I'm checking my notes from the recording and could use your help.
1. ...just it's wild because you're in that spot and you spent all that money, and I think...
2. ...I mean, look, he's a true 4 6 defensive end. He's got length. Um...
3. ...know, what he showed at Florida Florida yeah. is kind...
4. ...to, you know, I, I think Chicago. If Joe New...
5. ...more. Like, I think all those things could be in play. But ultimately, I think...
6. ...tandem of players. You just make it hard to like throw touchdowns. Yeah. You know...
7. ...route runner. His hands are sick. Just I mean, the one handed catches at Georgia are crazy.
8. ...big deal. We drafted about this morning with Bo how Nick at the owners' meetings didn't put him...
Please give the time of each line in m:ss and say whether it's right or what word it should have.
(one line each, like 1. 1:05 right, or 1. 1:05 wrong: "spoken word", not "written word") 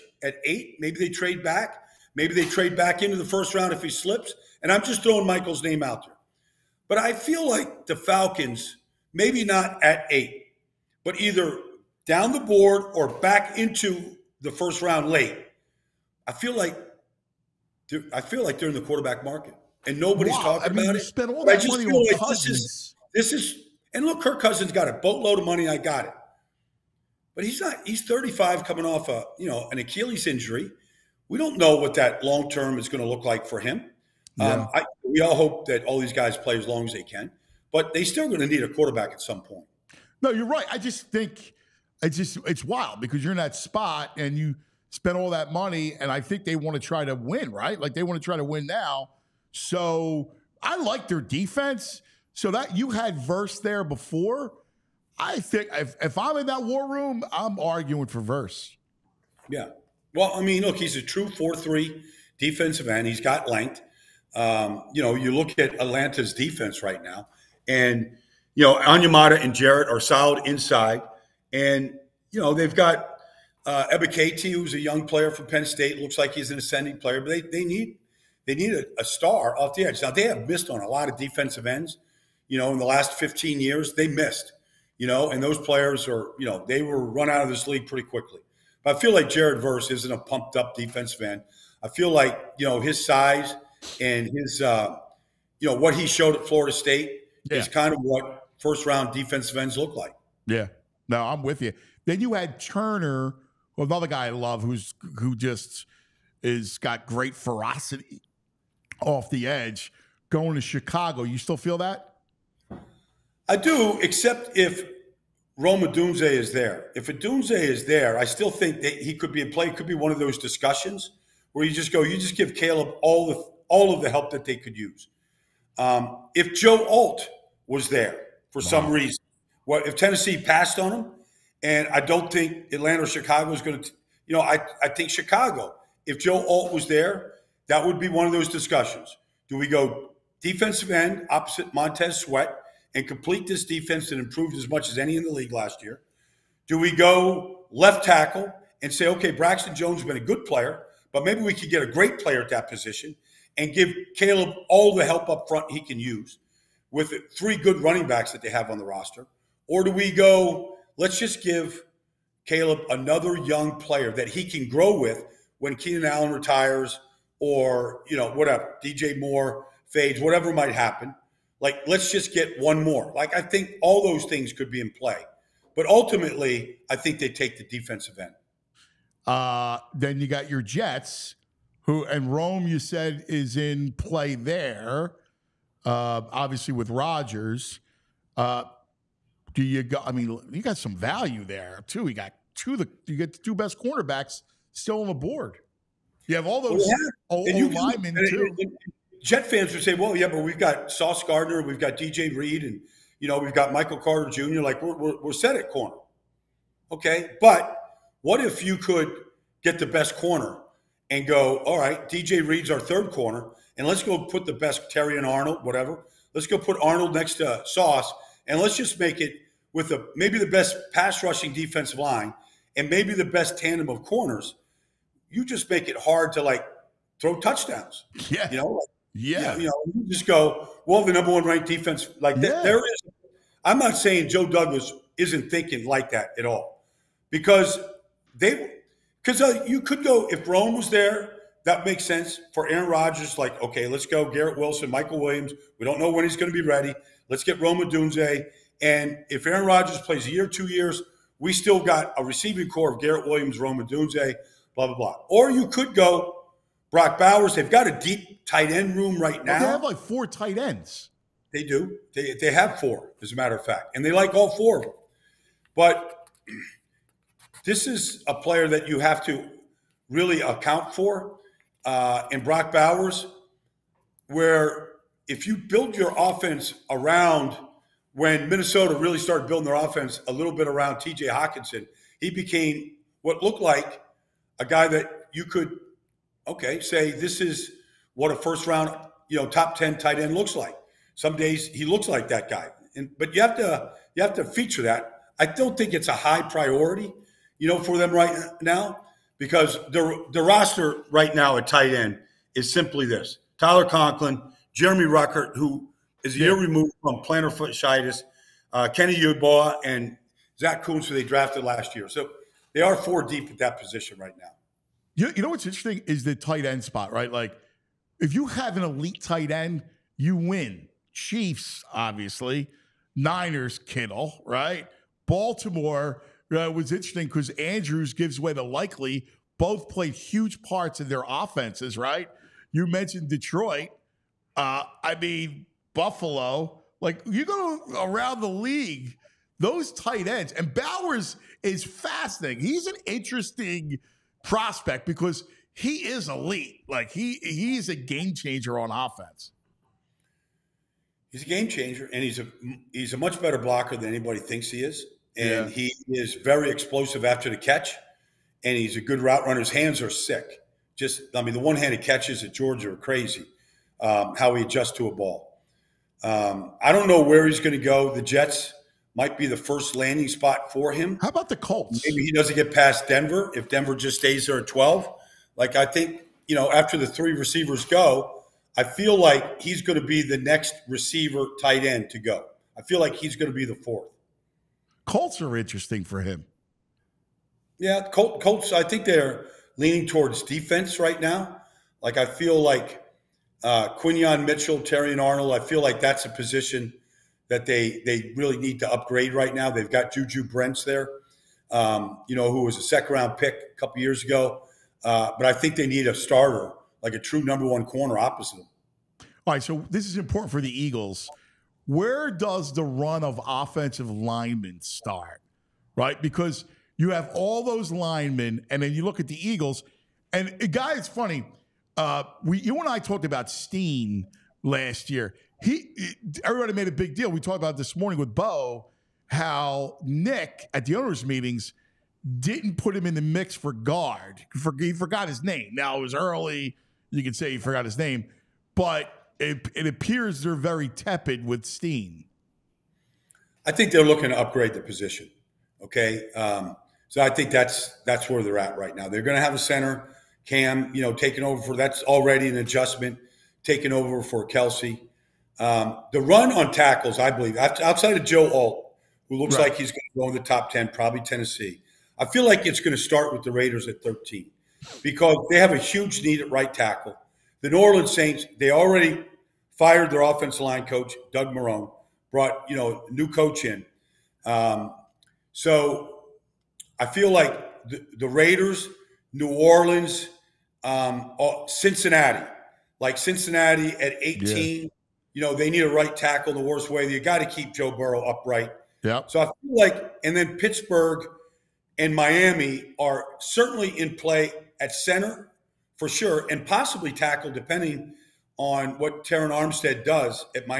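1. 0:42 right
2. 1:00 wrong: "3", not "6"
3. 1:35 wrong: "State", not "Florida"
4. 2:13 wrong: "Alt", not "New"
5. 2:52 right
6. 3:43 wrong: "corners", not "players"
7. 5:59 right
8. 7:06 wrong: "talked", not "drafted".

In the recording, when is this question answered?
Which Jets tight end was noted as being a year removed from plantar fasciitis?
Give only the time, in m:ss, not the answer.
5:04.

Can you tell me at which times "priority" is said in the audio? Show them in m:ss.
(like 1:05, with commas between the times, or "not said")
4:56.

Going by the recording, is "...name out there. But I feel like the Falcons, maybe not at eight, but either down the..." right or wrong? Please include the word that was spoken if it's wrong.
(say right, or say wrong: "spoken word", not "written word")
right.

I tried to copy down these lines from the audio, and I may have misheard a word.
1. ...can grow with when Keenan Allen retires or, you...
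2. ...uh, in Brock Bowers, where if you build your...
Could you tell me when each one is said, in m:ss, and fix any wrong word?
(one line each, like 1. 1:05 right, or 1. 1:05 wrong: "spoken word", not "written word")
1. 2:44 right
2. 4:31 right.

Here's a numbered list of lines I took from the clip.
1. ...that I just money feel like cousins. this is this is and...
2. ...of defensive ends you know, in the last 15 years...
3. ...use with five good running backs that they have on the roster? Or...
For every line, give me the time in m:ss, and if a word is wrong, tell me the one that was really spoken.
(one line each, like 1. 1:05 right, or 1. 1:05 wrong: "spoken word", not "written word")
1. 0:21 right
2. 1:21 right
3. 2:35 wrong: "three", not "five".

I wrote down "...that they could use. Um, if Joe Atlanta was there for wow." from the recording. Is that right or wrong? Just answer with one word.
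wrong.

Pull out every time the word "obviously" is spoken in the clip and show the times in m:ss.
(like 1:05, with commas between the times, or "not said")
3:06, 5:21.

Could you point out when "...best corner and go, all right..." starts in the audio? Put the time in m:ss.
3:29.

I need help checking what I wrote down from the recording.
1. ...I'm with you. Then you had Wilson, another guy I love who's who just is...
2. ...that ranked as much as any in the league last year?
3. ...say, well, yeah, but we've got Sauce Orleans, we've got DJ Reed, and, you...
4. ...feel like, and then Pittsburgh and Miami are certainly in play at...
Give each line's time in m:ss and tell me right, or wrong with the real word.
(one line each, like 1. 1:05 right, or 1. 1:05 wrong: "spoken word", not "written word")
1. 1:41 wrong: "Turner", not "Wilson"
2. 2:24 wrong: "improved", not "ranked"
3. 3:19 wrong: "Gardner", not "Orleans"
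4. 8:09 right.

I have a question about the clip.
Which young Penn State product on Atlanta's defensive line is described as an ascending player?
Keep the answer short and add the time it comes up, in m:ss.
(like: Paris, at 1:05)
Katie, at 1:14.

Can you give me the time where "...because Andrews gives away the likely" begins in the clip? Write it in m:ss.
5:27.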